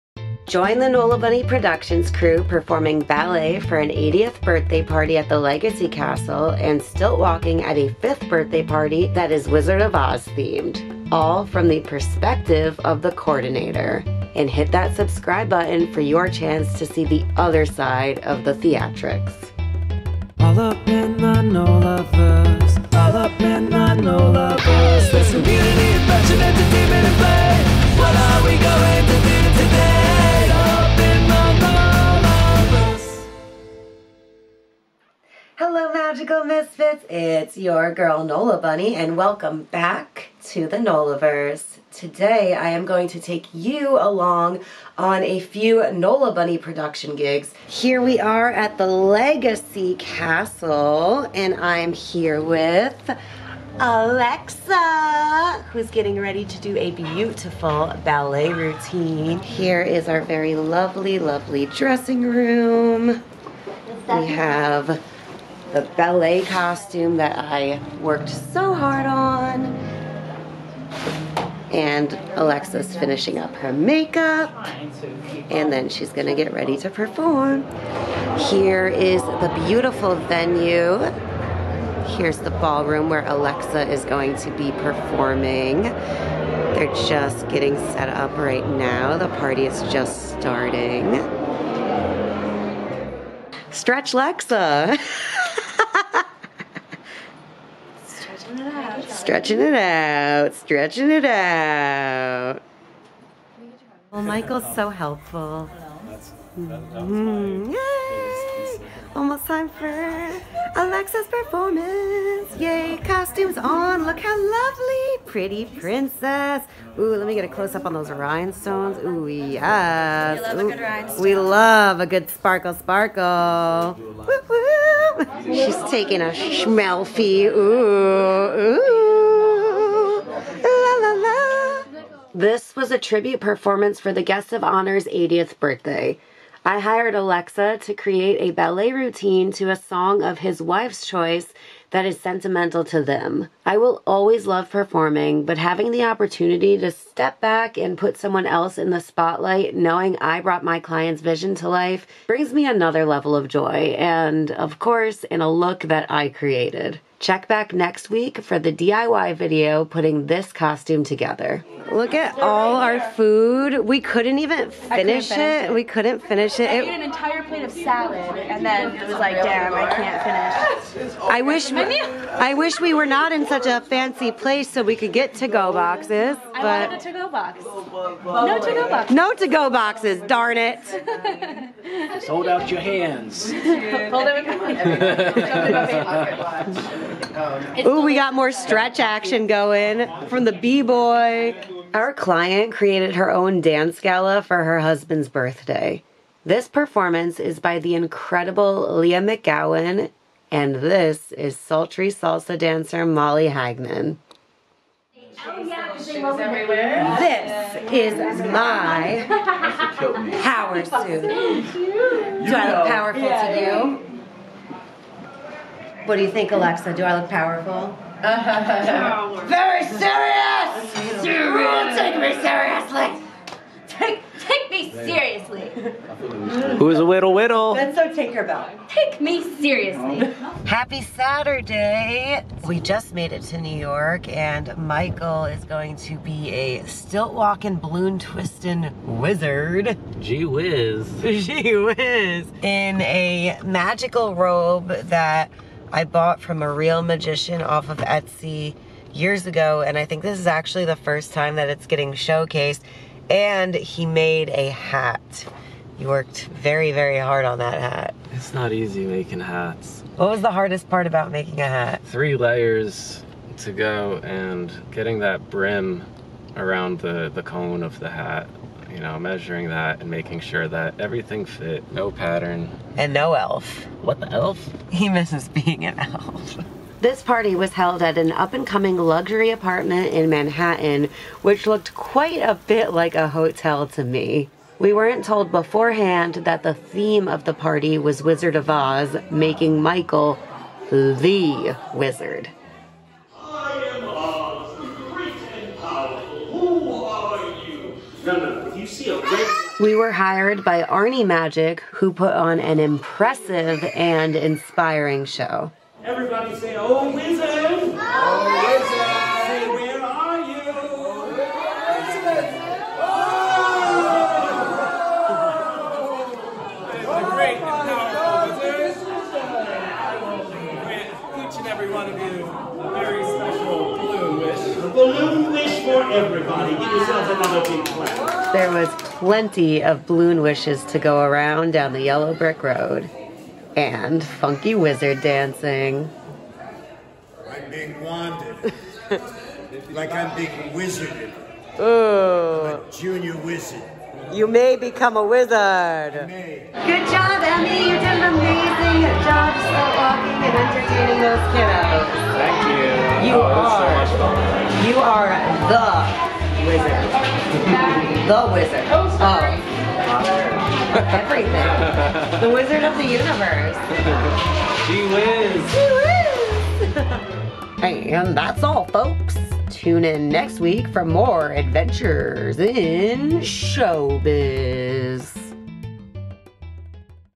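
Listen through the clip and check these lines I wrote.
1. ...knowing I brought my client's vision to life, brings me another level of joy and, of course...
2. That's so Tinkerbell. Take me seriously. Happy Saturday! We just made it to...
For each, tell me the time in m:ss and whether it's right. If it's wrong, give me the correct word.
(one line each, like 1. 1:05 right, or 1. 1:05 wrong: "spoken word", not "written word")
1. 2:29 right
2. 3:47 right.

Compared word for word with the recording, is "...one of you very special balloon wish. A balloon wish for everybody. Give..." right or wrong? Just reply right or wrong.
right.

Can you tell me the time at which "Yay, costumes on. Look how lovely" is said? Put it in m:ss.
1:52.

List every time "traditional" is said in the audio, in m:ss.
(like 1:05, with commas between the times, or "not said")
not said.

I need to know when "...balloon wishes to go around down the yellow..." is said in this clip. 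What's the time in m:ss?
5:30.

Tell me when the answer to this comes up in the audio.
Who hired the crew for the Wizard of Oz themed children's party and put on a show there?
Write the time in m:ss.
5:00.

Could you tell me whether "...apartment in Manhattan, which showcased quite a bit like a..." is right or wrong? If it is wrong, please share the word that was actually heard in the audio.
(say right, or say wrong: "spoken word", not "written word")
wrong: "looked", not "showcased".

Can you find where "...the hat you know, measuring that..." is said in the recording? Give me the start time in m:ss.
4:27.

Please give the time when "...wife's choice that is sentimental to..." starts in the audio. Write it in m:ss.
2:20.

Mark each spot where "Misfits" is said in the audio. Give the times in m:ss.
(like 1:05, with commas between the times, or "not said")
0:36.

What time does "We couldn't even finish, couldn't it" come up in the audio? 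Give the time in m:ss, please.
2:43.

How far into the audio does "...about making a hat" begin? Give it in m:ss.
4:21.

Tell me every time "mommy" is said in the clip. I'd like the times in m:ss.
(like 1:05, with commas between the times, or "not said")
not said.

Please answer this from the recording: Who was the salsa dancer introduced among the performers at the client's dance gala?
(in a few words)
Molly Hagman.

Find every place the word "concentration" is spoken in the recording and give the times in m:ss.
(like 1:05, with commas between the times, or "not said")
not said.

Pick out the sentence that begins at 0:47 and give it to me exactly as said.
Here we are at the Legacy Castle and I'm here with Alexa, who's getting ready to do a beautiful ballet routine.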